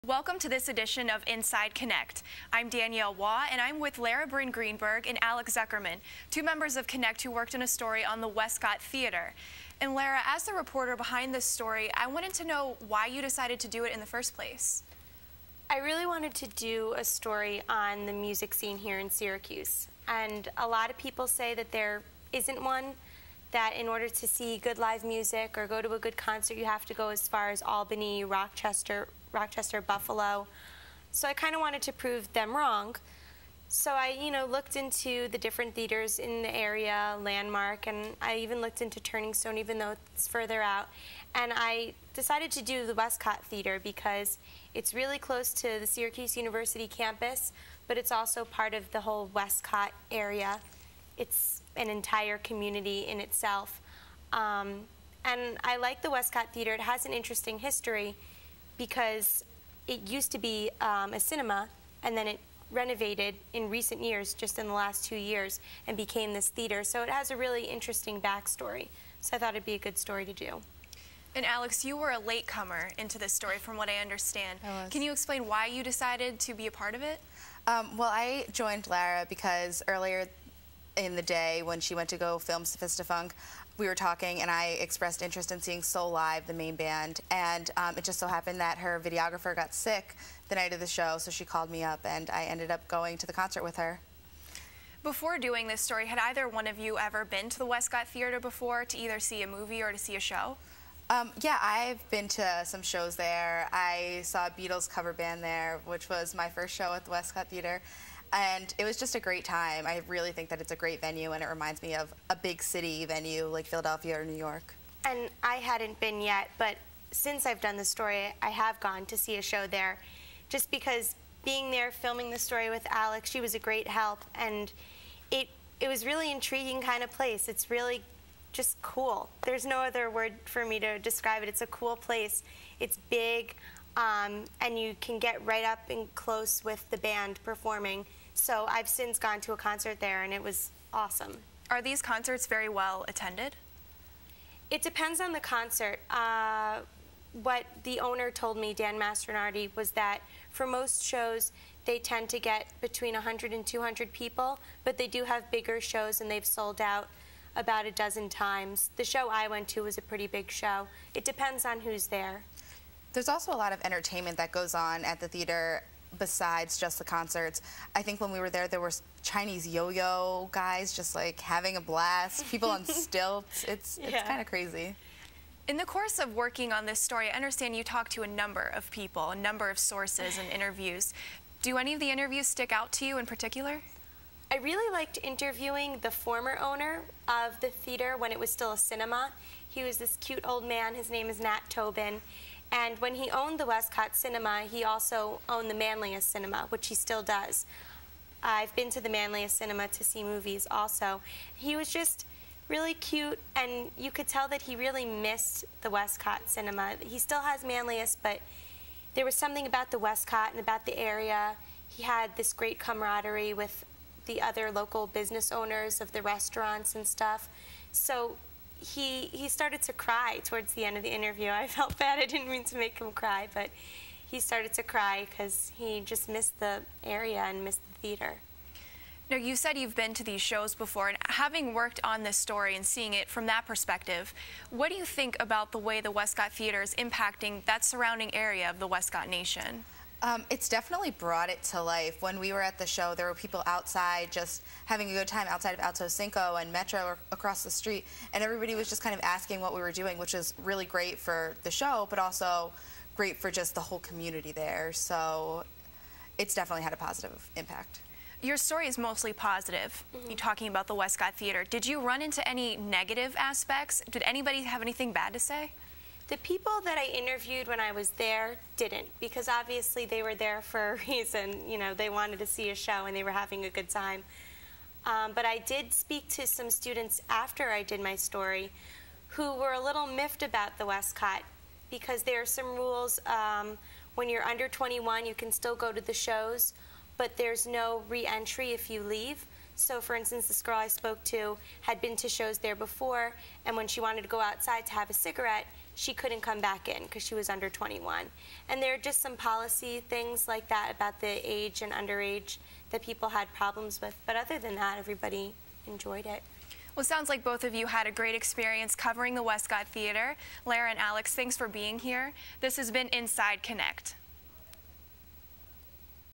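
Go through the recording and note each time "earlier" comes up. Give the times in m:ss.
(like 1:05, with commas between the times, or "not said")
1:19.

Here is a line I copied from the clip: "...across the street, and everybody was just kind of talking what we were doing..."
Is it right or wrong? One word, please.
wrong.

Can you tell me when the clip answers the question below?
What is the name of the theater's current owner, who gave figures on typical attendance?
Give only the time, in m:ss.
2:28.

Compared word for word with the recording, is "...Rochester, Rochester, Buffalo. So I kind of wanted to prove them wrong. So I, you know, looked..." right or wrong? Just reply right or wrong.
right.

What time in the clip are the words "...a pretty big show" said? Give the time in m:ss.
2:39.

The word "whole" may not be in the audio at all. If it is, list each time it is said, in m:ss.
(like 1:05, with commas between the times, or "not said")
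0:49, 4:13.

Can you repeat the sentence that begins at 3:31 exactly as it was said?
He had this great camaraderie with the other local business owners of the restaurants and stuff.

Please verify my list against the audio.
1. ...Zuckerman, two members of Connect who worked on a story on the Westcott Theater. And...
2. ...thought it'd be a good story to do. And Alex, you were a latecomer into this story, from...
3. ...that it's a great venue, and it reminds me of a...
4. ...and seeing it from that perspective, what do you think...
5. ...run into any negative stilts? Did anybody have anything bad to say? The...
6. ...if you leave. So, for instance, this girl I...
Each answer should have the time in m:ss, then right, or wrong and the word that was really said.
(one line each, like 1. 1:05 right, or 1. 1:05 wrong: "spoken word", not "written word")
1. 0:05 right
2. 1:09 right
3. 1:50 right
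4. 3:52 right
5. 4:22 wrong: "aspects", not "stilts"
6. 4:48 right.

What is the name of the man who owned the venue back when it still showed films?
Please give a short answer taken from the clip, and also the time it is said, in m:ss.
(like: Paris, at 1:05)
Nat Tobin, at 3:11.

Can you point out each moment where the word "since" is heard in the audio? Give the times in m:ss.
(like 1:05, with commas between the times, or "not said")
1:57, 2:18.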